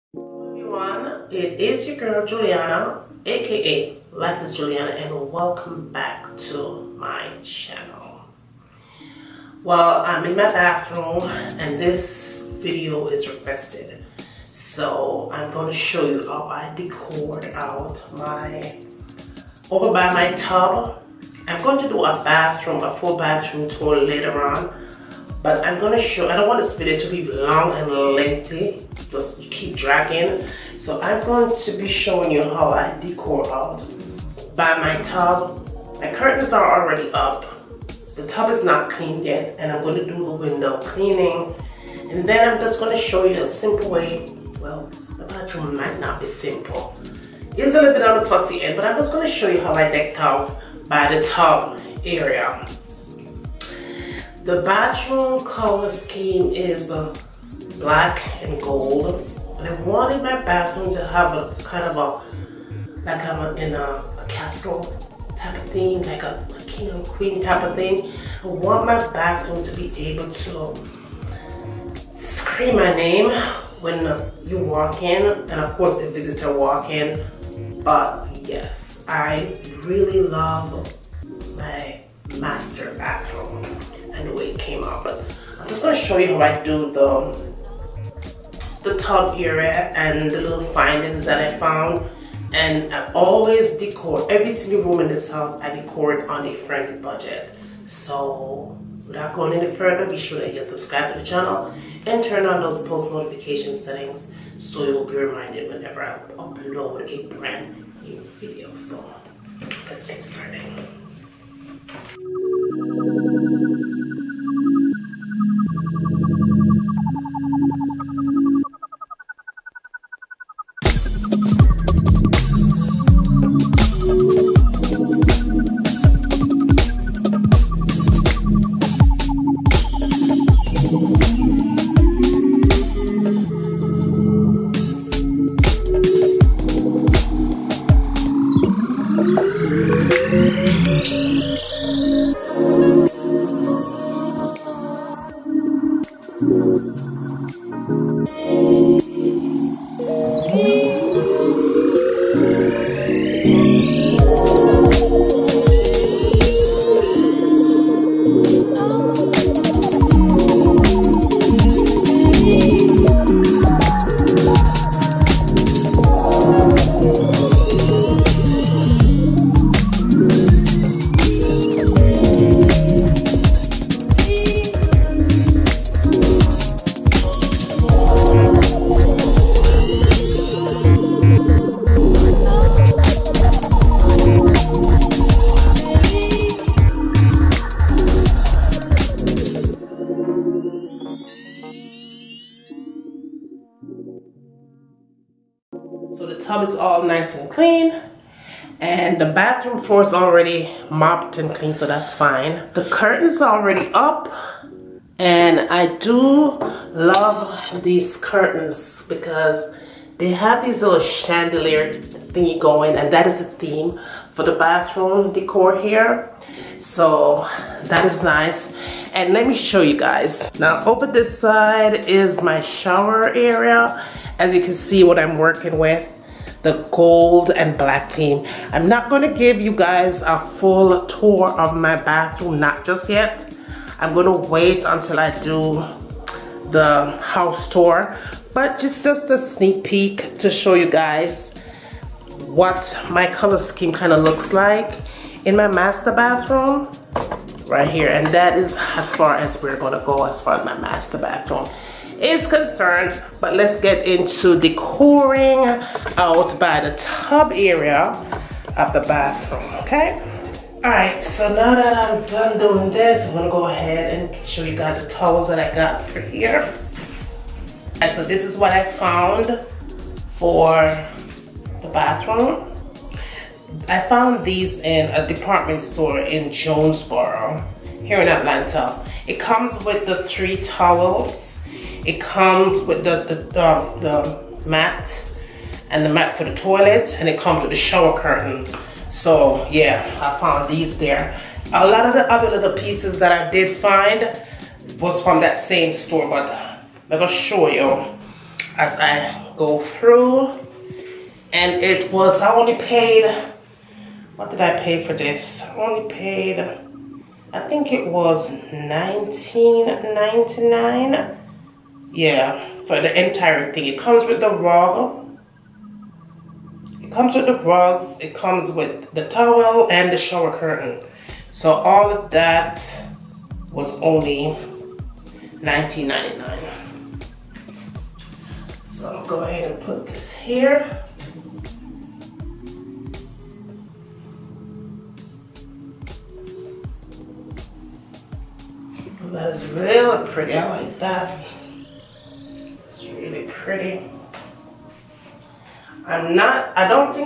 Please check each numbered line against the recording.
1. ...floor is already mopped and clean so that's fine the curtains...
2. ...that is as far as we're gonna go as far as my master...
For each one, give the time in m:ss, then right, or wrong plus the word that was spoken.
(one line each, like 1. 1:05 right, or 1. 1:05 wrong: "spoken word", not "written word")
1. 3:19 right
2. 4:08 right.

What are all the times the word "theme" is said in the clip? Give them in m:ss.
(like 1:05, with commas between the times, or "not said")
3:33, 3:48.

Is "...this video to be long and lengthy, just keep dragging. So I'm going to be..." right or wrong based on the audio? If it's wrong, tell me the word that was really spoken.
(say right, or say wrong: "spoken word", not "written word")
right.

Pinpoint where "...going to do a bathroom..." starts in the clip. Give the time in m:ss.
0:21.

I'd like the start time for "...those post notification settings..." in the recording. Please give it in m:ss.
1:42.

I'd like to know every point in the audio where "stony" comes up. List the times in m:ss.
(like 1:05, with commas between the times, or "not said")
not said.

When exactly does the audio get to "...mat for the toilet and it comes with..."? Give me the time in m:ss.
4:46.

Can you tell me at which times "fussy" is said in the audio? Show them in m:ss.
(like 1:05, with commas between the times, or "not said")
0:48.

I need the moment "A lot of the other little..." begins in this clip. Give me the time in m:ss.
4:51.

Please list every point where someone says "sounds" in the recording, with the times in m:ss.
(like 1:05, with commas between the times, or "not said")
not said.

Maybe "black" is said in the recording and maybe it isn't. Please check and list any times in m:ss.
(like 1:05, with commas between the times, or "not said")
0:57, 3:47.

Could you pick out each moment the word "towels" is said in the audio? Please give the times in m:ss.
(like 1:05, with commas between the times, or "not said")
4:25, 4:40, 5:19.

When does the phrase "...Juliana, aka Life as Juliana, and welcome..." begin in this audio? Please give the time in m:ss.
0:02.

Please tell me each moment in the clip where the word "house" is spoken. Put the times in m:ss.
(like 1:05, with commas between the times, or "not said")
1:35, 3:57.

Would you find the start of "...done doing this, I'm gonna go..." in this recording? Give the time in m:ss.
4:22.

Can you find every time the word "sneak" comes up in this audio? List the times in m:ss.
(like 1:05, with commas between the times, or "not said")
3:59.